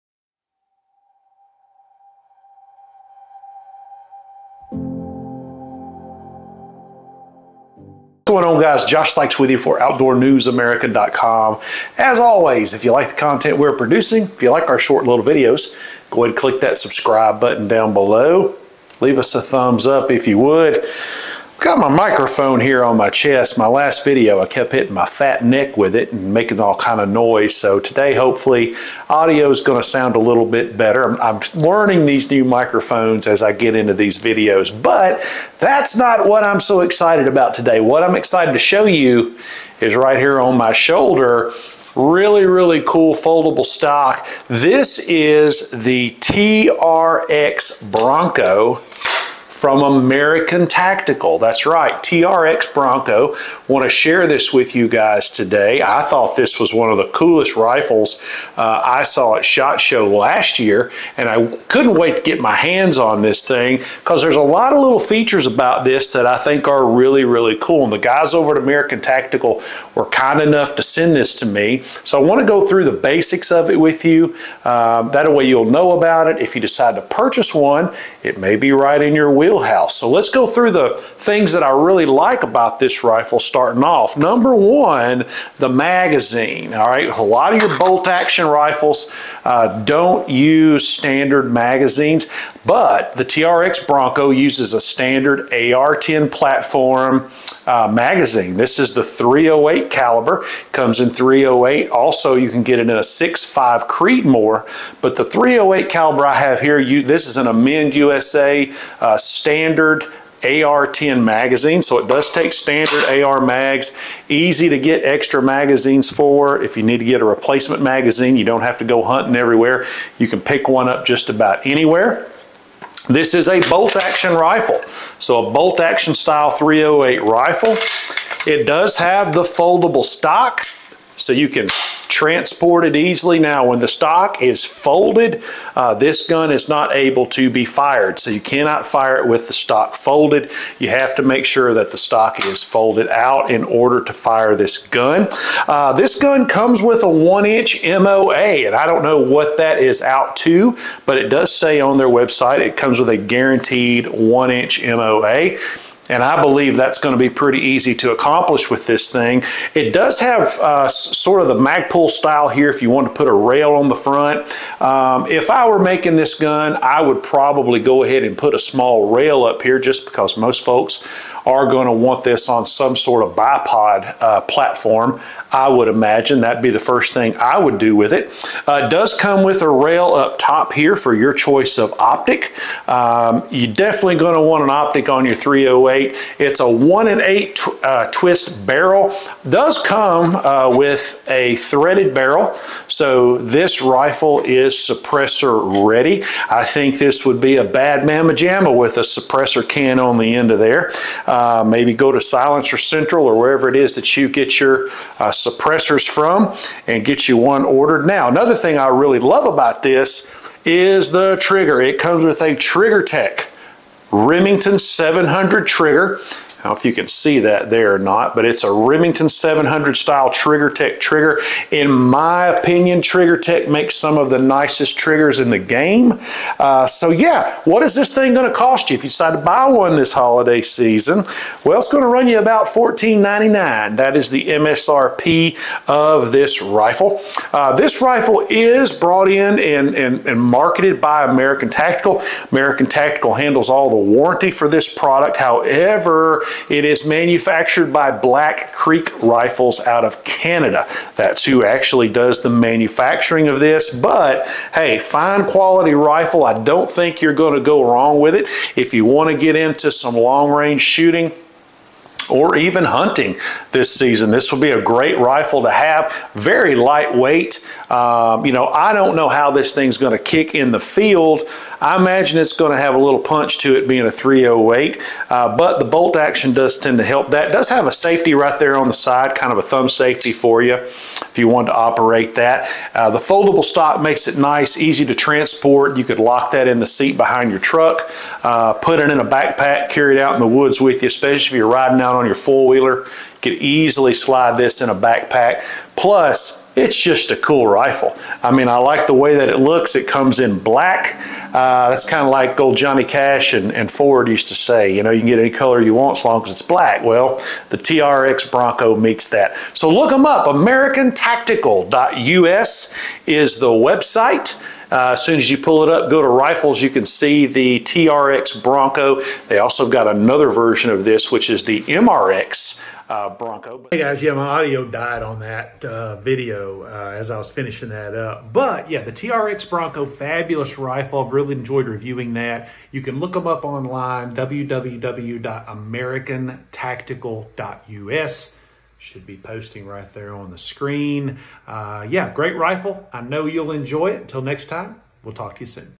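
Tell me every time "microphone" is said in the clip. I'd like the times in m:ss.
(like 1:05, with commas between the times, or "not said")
0:21, 0:32.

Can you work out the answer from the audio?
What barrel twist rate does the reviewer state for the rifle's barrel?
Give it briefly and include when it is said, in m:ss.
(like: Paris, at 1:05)
1 in 8, at 3:06.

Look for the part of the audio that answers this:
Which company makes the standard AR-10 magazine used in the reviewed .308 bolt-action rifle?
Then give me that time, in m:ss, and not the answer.
1:47.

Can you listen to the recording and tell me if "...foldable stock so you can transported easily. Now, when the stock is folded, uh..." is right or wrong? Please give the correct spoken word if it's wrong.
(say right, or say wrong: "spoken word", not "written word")
right.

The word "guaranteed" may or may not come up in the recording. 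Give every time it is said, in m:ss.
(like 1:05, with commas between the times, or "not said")
2:33.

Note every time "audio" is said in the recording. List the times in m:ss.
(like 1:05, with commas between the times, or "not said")
0:29, 5:24.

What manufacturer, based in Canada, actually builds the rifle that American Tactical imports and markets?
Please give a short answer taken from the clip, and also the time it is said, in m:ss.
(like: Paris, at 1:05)
Black Creek Rifles, at 4:08.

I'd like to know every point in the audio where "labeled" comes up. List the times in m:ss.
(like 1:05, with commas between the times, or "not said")
not said.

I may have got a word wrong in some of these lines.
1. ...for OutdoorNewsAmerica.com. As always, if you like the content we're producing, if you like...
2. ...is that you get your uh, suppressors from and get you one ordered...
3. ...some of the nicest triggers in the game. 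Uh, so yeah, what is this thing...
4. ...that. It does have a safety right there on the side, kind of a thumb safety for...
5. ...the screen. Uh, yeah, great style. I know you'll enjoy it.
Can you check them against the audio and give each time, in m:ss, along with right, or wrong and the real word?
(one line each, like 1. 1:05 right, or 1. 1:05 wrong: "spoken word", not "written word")
1. 0:09 right
2. 3:23 right
3. 3:43 right
4. 4:37 right
5. 5:40 wrong: "rifle", not "style".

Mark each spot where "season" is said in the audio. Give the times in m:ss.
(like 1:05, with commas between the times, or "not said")
3:50, 4:23.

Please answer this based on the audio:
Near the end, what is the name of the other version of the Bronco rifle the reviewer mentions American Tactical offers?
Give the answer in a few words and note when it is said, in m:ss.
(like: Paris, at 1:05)
MRX, at 5:21.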